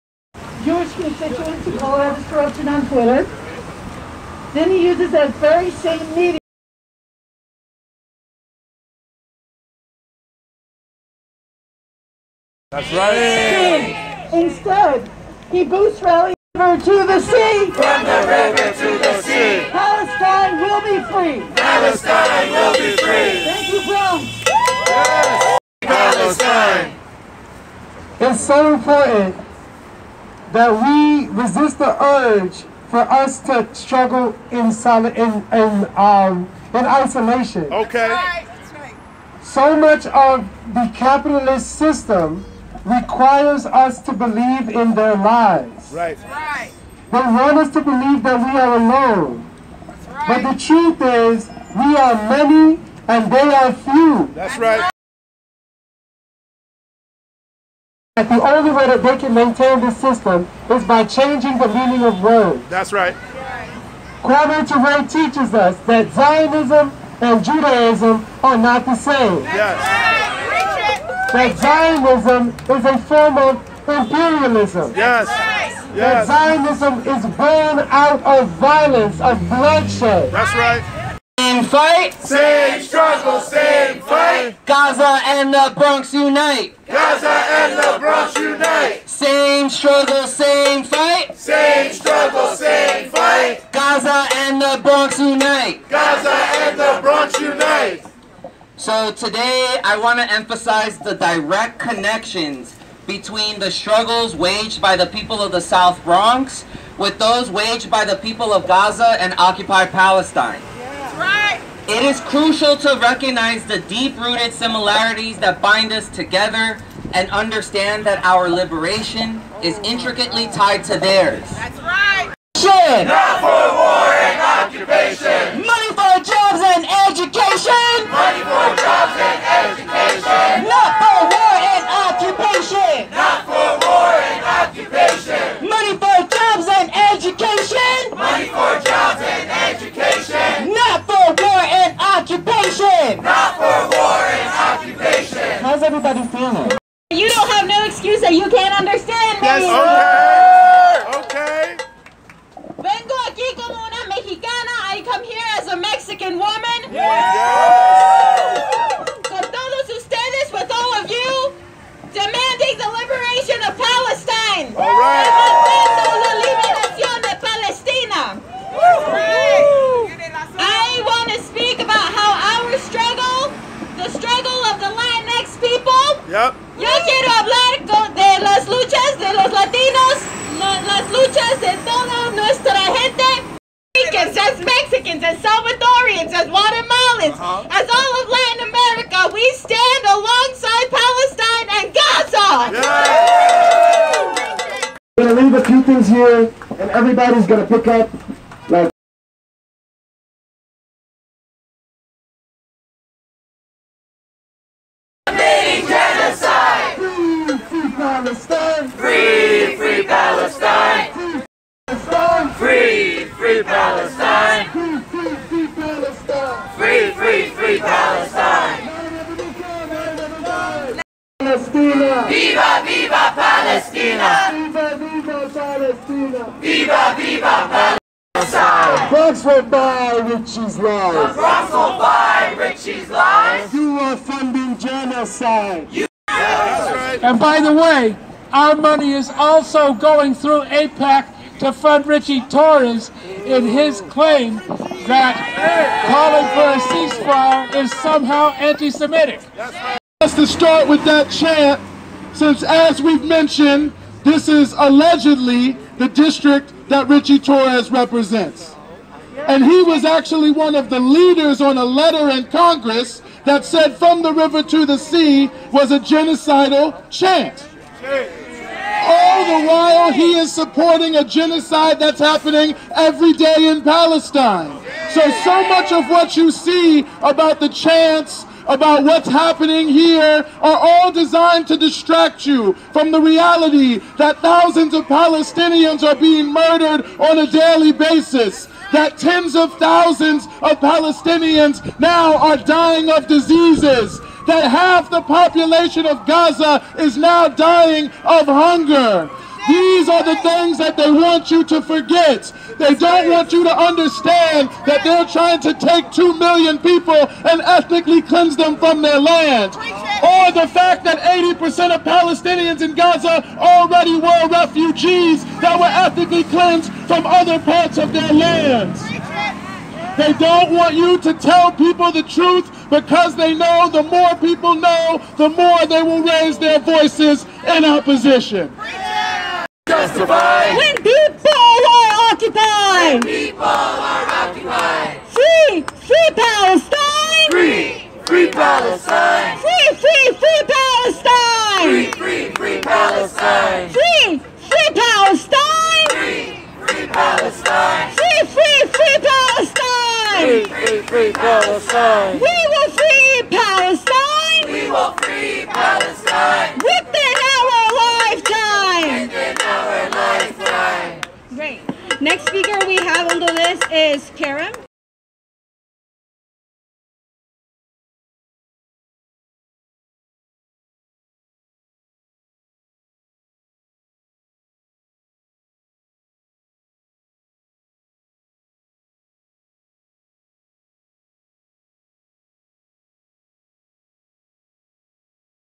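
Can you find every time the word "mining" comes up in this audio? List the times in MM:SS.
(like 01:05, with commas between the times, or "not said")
not said.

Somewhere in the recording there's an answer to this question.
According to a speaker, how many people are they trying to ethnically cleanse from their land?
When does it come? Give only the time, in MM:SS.
05:06.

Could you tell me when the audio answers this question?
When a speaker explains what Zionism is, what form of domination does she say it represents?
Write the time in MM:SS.
01:13.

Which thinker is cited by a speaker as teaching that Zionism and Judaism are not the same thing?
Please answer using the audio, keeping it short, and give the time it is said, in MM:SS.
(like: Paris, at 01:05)
Kwame Ture, at 01:04.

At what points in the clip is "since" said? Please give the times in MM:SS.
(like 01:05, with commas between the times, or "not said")
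04:12.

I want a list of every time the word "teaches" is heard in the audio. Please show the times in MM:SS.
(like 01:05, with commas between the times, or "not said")
01:05.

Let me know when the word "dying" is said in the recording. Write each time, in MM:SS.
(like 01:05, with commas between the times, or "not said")
04:52, 04:57.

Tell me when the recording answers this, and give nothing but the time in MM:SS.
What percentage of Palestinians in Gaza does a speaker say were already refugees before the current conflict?
05:11.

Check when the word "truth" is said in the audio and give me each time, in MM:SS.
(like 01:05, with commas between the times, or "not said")
00:50, 05:22.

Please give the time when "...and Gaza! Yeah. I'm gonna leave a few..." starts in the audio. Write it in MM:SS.
03:11.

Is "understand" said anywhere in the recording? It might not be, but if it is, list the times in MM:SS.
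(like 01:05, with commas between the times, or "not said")
01:57, 02:28, 05:03.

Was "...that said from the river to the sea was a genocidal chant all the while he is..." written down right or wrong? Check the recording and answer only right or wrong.
right.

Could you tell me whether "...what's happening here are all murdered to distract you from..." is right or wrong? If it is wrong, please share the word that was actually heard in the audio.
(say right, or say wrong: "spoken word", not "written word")
wrong: "designed", not "murdered".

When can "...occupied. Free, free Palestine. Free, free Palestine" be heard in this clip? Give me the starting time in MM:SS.
05:34.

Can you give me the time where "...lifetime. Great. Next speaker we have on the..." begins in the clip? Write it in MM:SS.
06:00.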